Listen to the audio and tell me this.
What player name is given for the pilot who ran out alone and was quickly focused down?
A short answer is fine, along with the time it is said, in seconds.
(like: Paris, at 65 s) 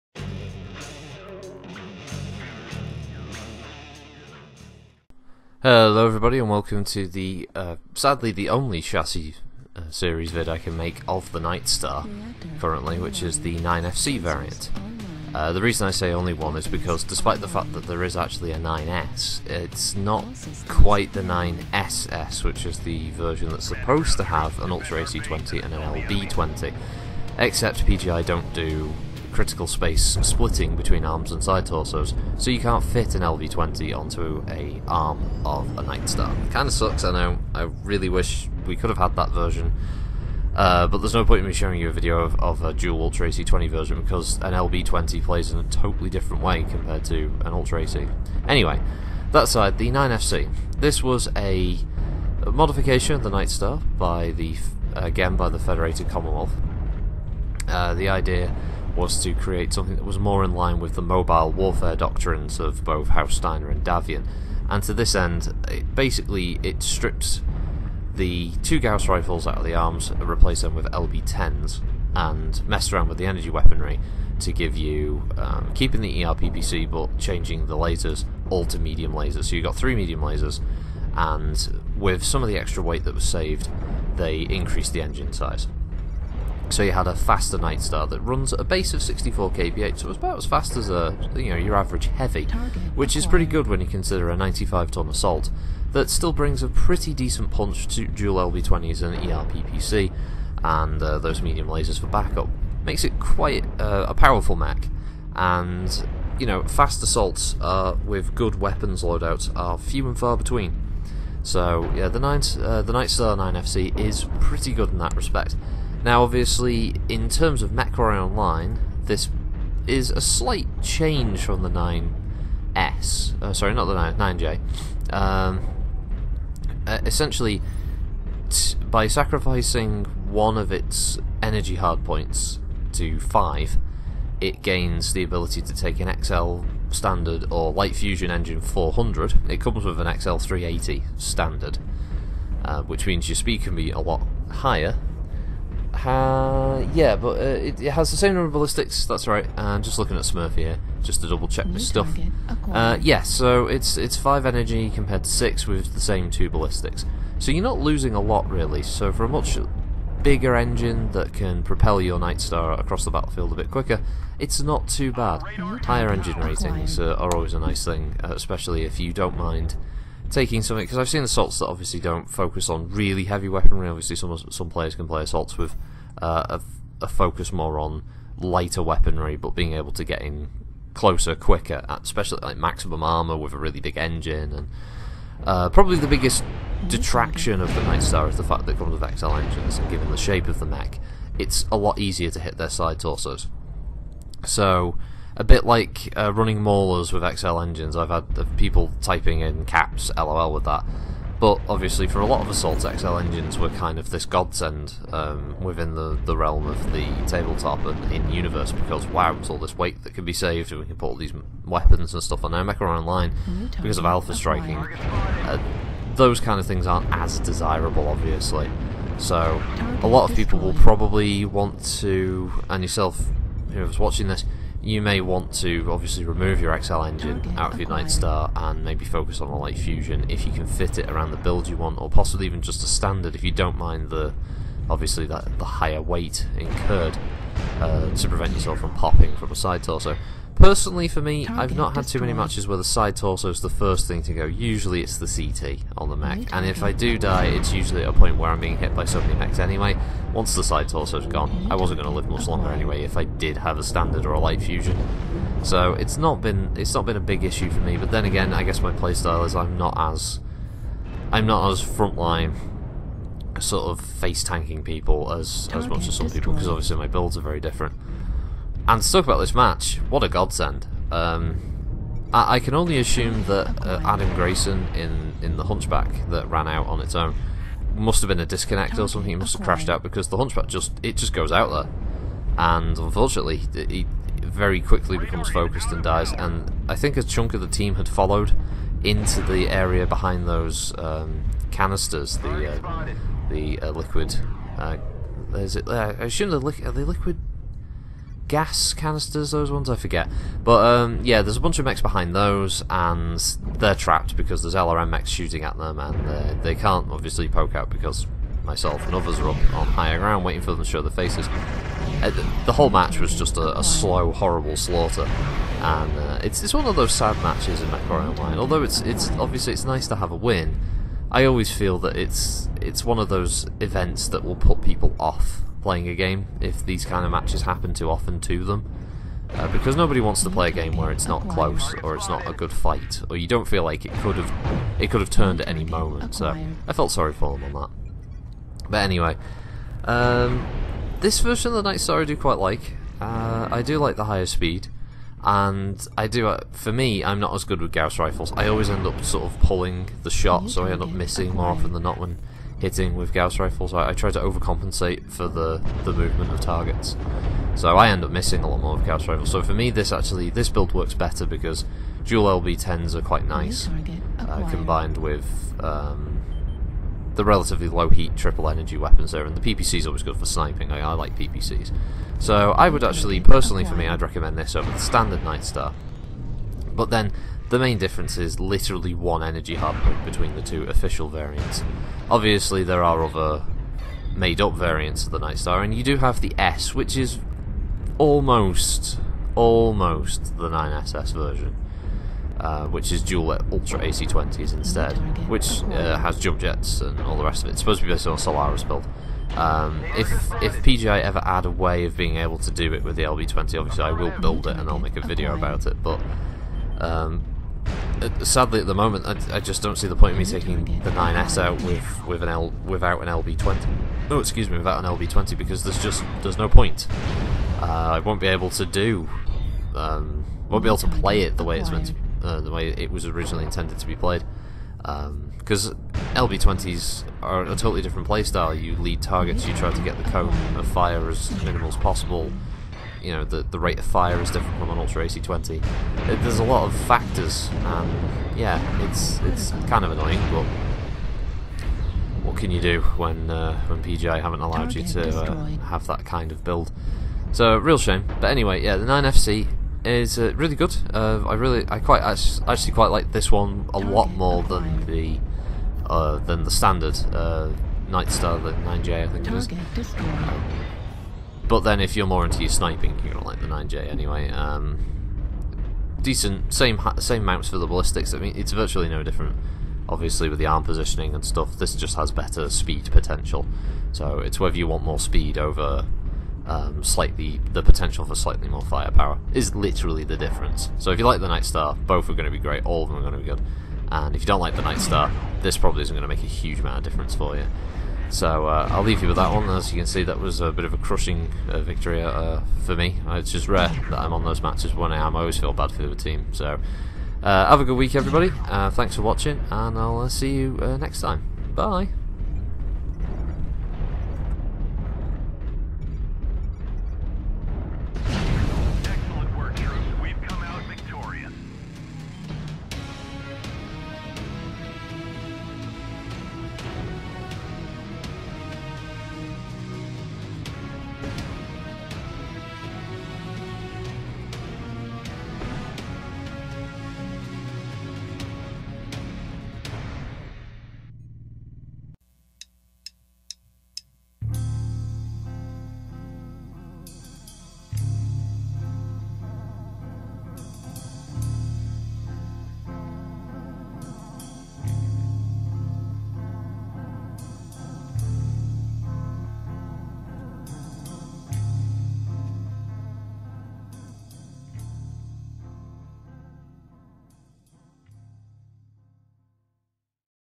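Adam Grayson, at 274 s.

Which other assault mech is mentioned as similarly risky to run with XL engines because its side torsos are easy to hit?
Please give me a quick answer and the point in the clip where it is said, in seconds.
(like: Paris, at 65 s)
Maulers, at 196 s.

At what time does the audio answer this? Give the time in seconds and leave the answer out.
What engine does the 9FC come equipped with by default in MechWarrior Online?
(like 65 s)
140 s.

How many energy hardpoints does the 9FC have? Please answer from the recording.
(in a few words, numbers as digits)
5.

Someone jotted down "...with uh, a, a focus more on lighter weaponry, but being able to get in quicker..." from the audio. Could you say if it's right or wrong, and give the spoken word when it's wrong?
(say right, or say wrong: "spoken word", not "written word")
wrong: "closer", not "quicker".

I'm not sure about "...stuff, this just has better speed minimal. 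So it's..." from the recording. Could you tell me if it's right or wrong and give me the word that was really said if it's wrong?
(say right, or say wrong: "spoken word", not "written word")
wrong: "potential", not "minimal".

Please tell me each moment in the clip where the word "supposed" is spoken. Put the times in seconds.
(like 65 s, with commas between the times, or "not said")
23 s, 397 s.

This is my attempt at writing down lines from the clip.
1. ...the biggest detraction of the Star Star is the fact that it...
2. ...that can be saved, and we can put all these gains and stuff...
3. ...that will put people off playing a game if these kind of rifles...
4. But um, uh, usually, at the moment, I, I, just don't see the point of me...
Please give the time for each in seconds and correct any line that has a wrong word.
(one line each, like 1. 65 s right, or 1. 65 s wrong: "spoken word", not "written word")
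1. 185 s wrong: "Night", not "Star"
2. 210 s wrong: "weapons", not "gains"
3. 324 s wrong: "matches", not "rifles"
4. 406 s wrong: "sadly", not "usually".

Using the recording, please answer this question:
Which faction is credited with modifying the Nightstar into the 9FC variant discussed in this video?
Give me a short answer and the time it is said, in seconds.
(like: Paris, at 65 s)
Federated Commonwealth, at 55 s.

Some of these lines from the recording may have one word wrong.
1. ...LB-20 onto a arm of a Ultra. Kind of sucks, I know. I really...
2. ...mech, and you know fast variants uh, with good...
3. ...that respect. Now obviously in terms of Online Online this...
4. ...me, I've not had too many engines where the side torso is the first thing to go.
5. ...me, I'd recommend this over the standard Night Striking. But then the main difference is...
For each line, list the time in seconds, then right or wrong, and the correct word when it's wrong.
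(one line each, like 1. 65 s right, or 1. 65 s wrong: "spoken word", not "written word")
1. 33 s wrong: "Nightstar", not "Ultra"
2. 104 s wrong: "assaults", not "variants"
3. 114 s wrong: "MechWarrior", not "Online"
4. 241 s wrong: "matches", not "engines"
5. 373 s wrong: "Star", not "Striking".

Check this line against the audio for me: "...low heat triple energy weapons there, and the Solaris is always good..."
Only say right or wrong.
wrong.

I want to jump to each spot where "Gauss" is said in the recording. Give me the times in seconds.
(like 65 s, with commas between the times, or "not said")
68 s, 347 s, 353 s, 359 s.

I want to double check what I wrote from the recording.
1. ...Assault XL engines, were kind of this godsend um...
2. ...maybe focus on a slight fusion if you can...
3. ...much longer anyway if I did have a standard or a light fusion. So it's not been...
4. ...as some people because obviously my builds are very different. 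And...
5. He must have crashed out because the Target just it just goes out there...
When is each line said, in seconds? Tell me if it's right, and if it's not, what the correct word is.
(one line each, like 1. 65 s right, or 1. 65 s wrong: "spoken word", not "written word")
1. 202 s right
2. 228 s wrong: "light", not "slight"
3. 252 s right
4. 266 s right
5. 279 s wrong: "Hunchback", not "Target".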